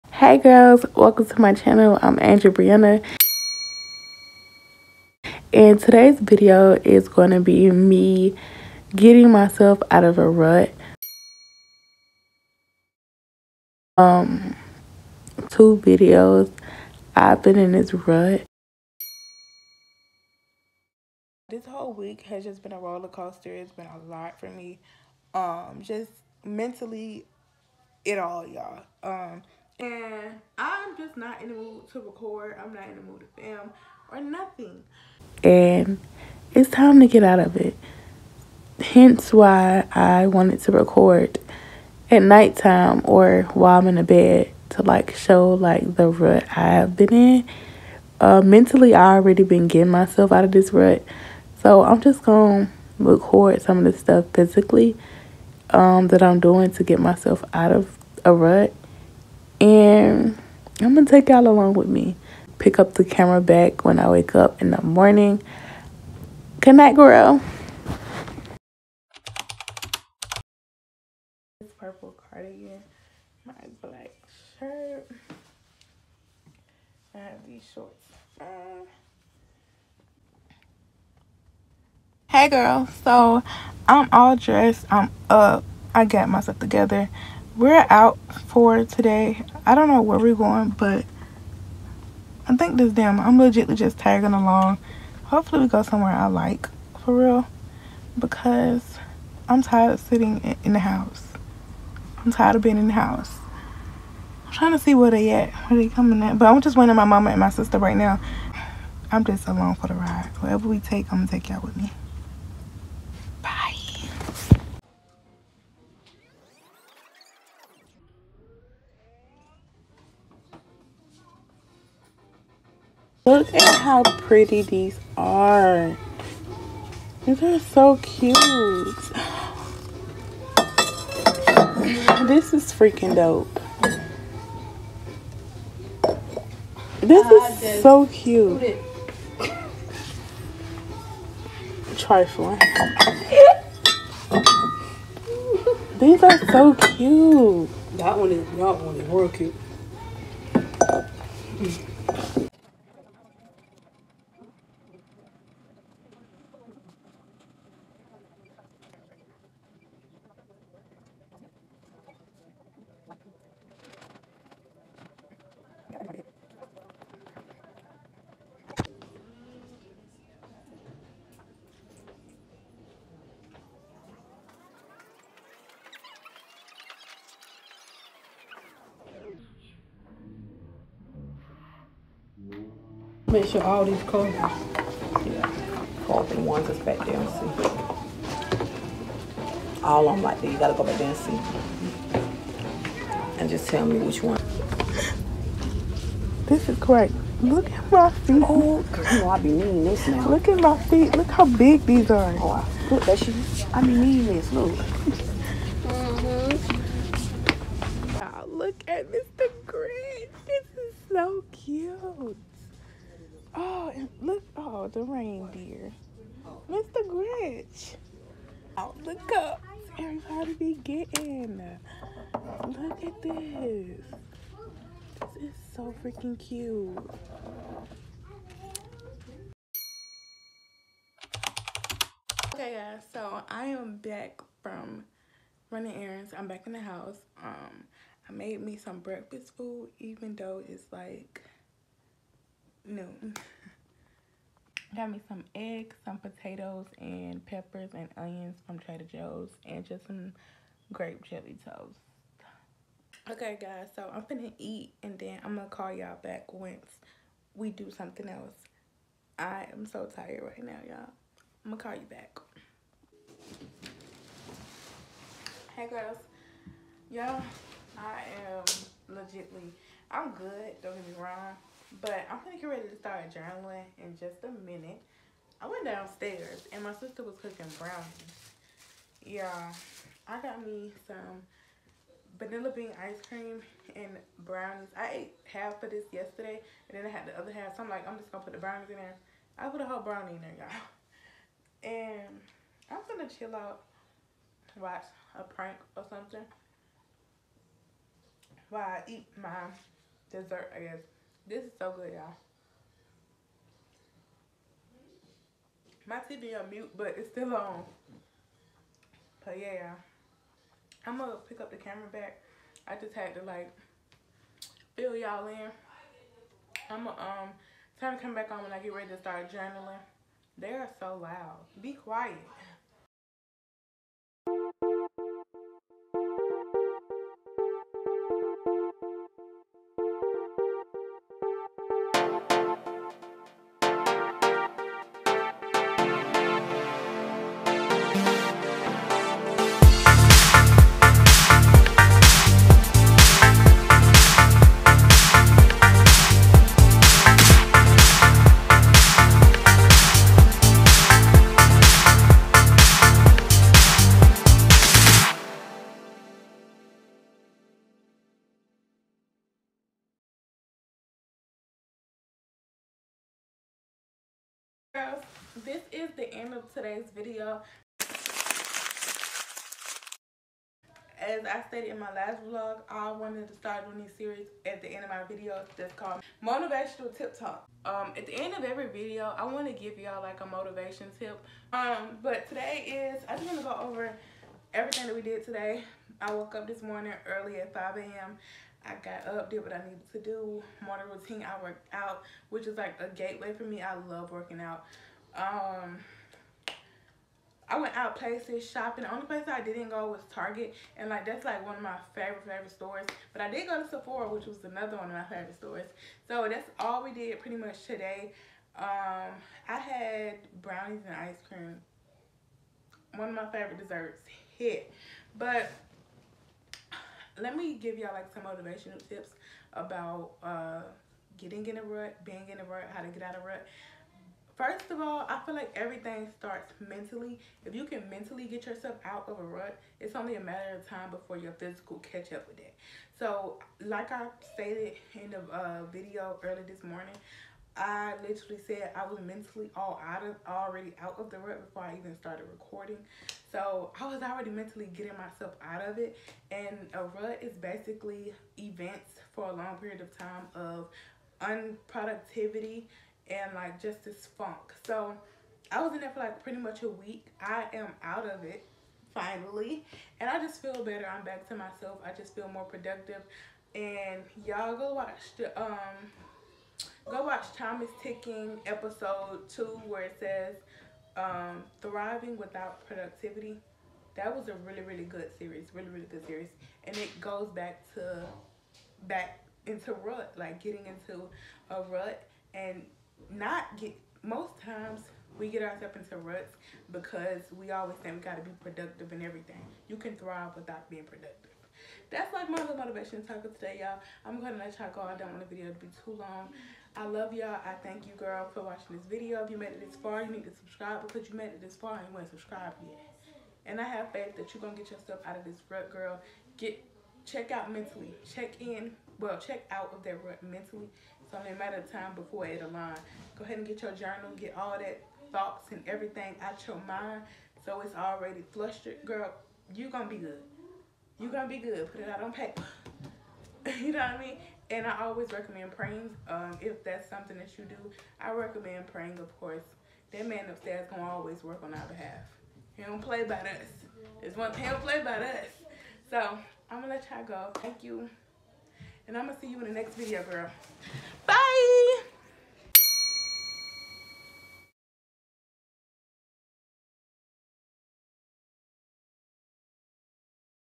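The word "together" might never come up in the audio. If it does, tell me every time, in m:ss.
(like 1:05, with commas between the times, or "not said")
1:26.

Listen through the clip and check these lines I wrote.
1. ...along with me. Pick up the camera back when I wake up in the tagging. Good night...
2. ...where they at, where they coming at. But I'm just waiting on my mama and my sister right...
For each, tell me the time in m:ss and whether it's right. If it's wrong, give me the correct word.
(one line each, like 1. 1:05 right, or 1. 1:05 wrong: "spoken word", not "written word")
1. 1:01 wrong: "morning", not "tagging"
2. 1:44 right.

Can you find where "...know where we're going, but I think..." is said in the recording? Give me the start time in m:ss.
1:29.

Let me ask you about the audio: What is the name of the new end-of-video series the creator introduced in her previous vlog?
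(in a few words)
Motivational Tip Talk.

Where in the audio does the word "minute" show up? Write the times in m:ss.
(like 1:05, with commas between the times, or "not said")
4:34.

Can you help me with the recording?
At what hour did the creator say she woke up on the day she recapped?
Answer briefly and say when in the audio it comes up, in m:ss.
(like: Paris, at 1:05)
5 a.m., at 6:27.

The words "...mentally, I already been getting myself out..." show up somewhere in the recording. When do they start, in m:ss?
0:48.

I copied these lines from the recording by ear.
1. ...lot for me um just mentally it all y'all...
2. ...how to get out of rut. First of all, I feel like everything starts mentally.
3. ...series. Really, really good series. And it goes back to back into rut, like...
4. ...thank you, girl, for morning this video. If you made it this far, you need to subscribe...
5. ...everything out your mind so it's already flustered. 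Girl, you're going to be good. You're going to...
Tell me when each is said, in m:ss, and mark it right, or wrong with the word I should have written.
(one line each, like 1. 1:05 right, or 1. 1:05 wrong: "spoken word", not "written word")
1. 0:24 right
2. 7:02 right
3. 7:55 right
4. 8:17 wrong: "watching", not "morning"
5. 8:35 right.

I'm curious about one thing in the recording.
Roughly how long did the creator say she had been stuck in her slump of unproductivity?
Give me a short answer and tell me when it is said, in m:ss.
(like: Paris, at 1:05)
A week, at 7:36.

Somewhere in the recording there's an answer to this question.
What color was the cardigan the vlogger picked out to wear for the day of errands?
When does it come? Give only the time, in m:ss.
1:11.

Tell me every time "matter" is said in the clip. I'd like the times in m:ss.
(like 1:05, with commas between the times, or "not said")
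7:10, 8:31.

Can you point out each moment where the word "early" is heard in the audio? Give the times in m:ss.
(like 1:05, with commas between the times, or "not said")
6:27, 7:16.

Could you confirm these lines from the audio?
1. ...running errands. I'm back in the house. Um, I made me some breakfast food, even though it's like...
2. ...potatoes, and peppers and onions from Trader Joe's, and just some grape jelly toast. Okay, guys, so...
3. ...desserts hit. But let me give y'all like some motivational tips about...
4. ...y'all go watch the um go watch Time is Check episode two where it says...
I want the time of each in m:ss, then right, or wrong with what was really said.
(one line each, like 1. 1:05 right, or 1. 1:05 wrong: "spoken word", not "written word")
1. 3:55 right
2. 4:06 right
3. 6:53 right
4. 7:44 wrong: "Ticking", not "Check".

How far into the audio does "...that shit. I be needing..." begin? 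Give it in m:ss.
3:23.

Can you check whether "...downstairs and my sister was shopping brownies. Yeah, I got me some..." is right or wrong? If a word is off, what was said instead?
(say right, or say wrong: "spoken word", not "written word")
wrong: "cooking", not "shopping".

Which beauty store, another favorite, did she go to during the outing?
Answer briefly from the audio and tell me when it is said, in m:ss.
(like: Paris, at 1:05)
Sephora, at 6:43.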